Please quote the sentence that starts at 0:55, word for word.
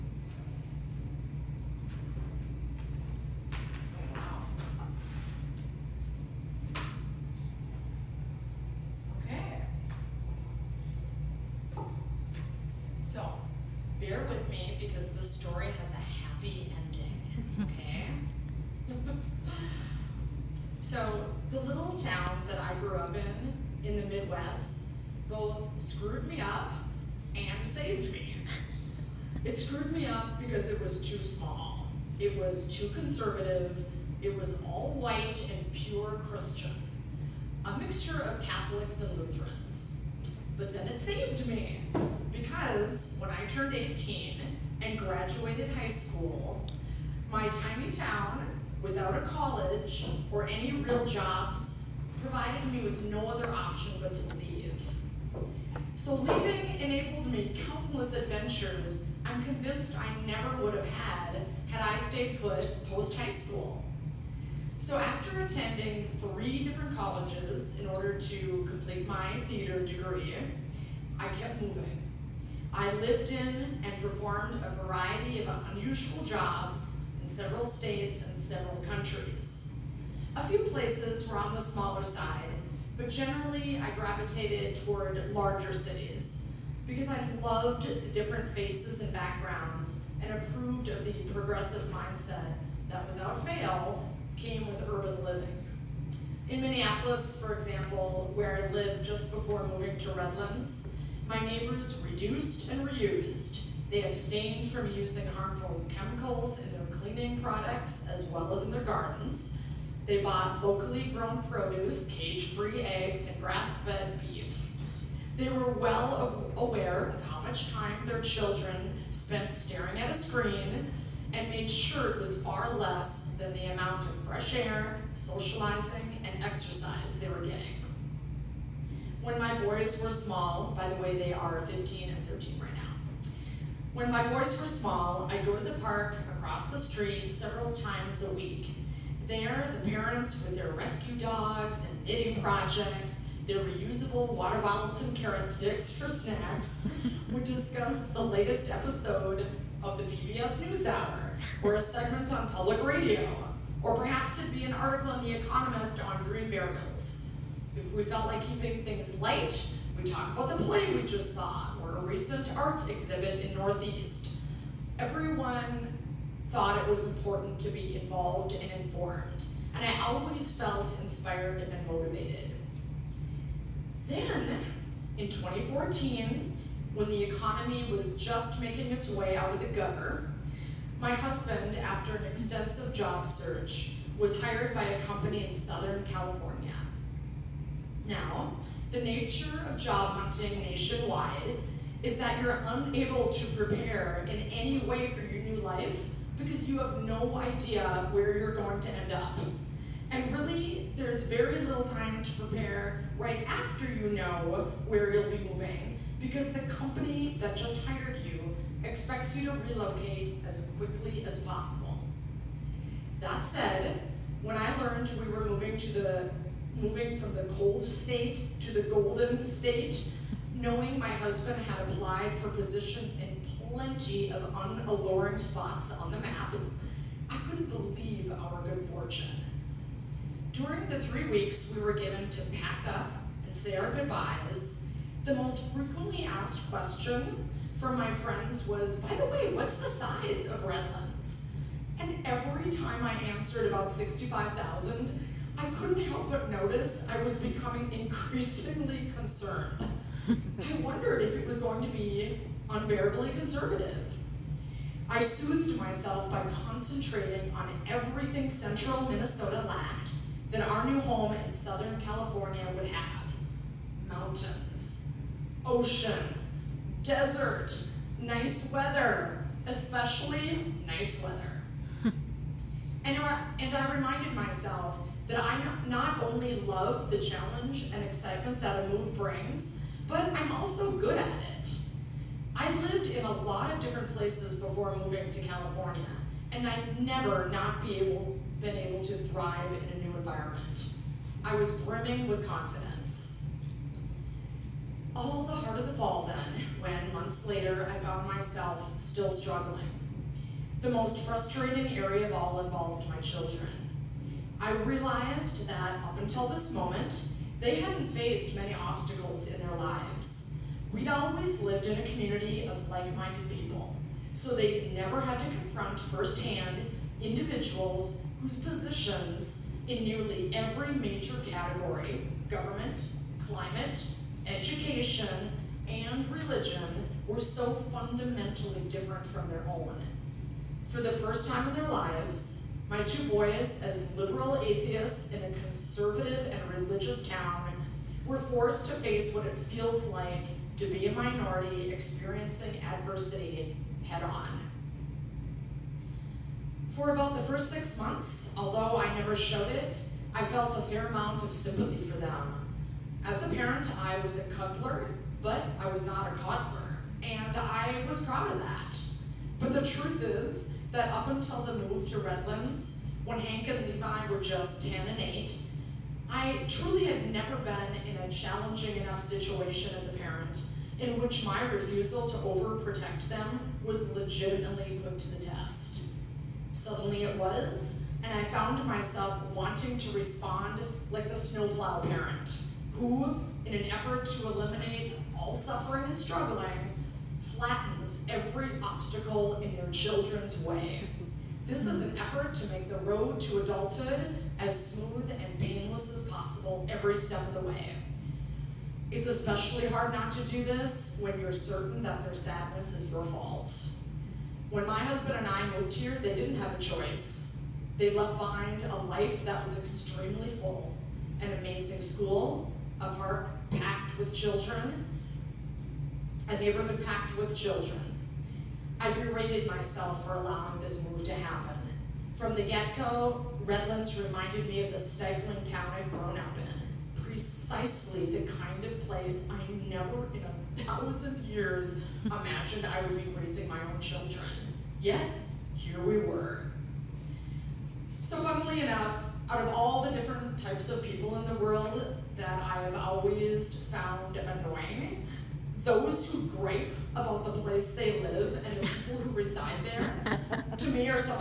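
So leaving enabled me countless adventures I'm convinced I never would have had had I stayed put post high school.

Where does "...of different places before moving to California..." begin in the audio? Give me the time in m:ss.
4:43.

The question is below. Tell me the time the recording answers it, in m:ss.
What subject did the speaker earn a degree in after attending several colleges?
1:09.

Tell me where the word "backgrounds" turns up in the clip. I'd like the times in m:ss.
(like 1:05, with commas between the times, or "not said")
1:29.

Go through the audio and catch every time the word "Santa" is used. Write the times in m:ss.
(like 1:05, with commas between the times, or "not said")
not said.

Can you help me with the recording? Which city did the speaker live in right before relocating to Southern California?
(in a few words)
Minneapolis.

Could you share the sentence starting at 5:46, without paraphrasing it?
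For about the first six months, although I never showed it, I felt a fair amount of sympathy for them.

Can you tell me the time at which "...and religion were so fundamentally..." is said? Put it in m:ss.
5:25.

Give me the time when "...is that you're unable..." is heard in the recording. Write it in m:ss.
3:12.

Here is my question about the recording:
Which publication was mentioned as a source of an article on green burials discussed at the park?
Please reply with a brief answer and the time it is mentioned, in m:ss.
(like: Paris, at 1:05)
The Economist, at 2:35.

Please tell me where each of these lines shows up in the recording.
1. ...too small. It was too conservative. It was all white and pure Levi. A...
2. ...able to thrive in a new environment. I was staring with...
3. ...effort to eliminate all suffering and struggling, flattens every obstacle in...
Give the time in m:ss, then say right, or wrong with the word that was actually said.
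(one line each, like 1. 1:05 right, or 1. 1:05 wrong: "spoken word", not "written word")
1. 0:31 wrong: "Christian", not "Levi"
2. 4:48 wrong: "brimming", not "staring"
3. 6:23 right.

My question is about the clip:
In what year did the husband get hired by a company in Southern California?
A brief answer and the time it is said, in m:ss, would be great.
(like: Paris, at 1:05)
2014, at 2:55.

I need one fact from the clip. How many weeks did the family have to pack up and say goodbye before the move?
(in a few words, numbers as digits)
3.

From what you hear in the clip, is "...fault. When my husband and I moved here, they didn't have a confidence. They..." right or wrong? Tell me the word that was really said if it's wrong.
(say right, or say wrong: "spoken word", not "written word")
wrong: "choice", not "confidence".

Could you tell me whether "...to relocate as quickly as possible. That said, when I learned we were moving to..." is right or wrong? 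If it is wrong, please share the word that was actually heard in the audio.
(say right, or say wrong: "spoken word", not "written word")
right.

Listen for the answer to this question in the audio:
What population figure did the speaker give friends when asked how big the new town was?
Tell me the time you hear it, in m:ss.
4:03.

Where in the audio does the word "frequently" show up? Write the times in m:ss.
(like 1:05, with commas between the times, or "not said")
3:55.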